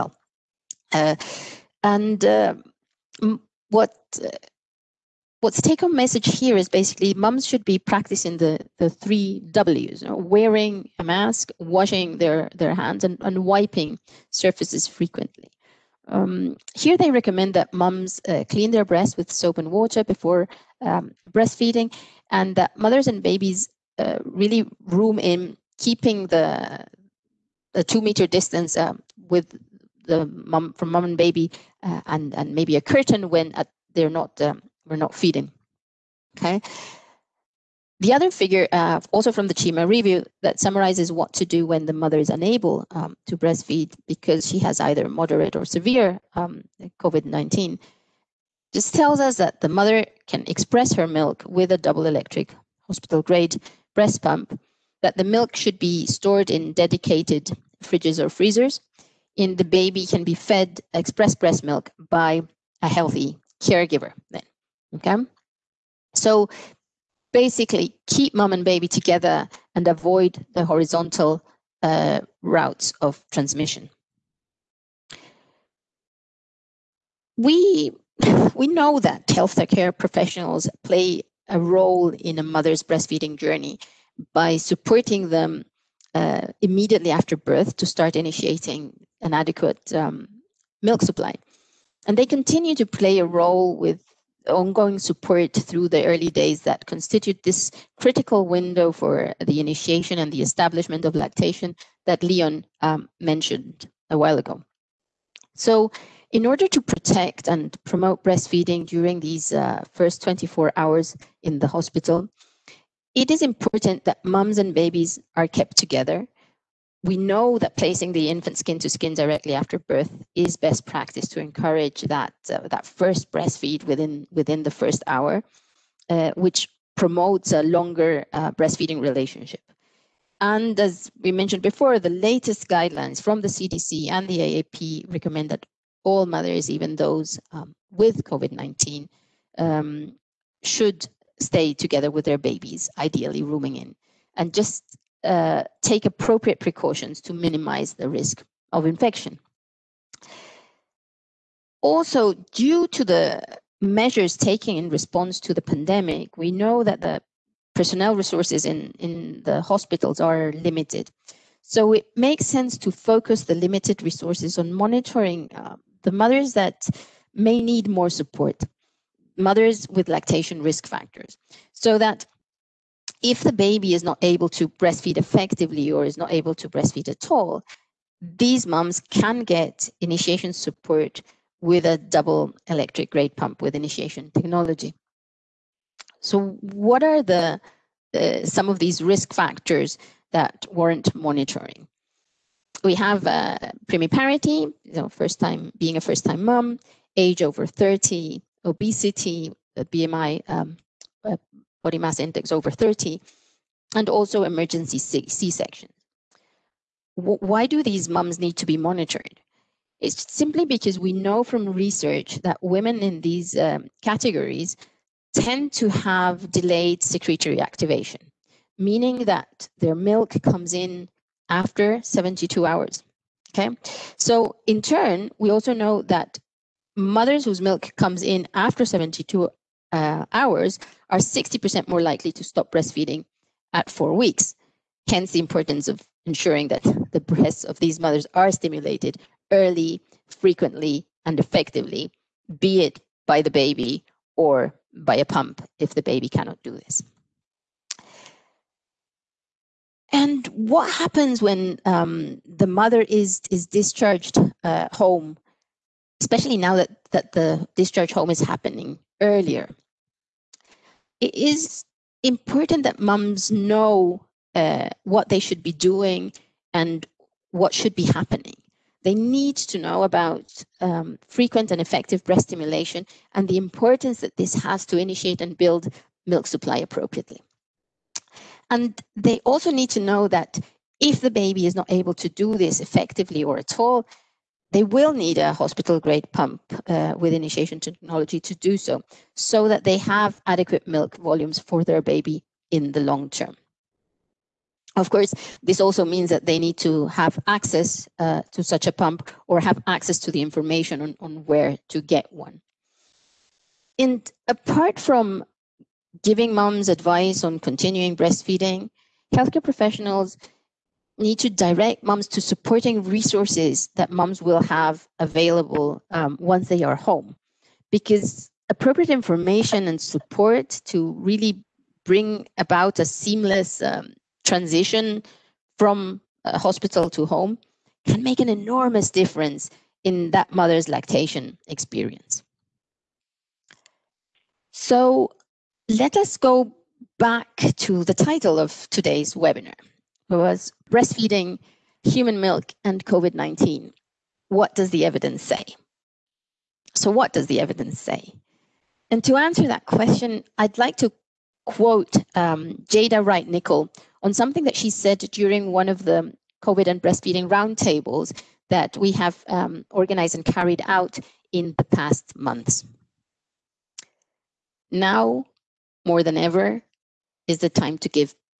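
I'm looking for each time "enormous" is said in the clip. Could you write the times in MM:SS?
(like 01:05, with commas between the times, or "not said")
05:28.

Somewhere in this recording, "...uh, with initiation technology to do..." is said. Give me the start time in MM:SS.
04:46.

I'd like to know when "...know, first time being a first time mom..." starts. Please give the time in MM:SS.
03:14.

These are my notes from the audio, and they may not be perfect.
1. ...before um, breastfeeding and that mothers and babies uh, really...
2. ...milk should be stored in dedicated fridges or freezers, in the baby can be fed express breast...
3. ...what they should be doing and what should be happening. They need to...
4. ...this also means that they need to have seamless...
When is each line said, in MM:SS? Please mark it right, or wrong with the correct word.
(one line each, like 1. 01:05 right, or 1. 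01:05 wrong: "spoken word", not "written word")
1. 00:20 right
2. 00:55 right
3. 04:25 right
4. 04:55 wrong: "access", not "seamless".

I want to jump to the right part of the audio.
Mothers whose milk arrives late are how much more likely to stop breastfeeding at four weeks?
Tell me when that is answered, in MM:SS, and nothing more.
03:51.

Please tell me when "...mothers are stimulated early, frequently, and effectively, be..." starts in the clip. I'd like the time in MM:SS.
03:57.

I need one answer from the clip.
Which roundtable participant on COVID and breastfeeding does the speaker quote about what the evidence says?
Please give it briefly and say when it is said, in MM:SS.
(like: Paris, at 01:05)
Jada Wright Nickel, at 05:52.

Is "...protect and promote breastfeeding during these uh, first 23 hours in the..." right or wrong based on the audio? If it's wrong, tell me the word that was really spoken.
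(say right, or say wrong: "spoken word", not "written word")
wrong: "24", not "23".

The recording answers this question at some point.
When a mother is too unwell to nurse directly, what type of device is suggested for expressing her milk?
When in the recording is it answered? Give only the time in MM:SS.
00:51.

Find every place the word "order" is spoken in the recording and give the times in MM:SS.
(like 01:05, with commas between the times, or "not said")
01:46.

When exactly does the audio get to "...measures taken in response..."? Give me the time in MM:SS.
02:33.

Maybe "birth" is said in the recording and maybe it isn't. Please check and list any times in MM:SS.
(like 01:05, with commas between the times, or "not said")
01:27, 01:59.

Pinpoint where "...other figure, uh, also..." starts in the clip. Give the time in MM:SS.
00:38.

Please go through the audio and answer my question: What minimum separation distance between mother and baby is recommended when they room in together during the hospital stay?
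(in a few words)
2 meters.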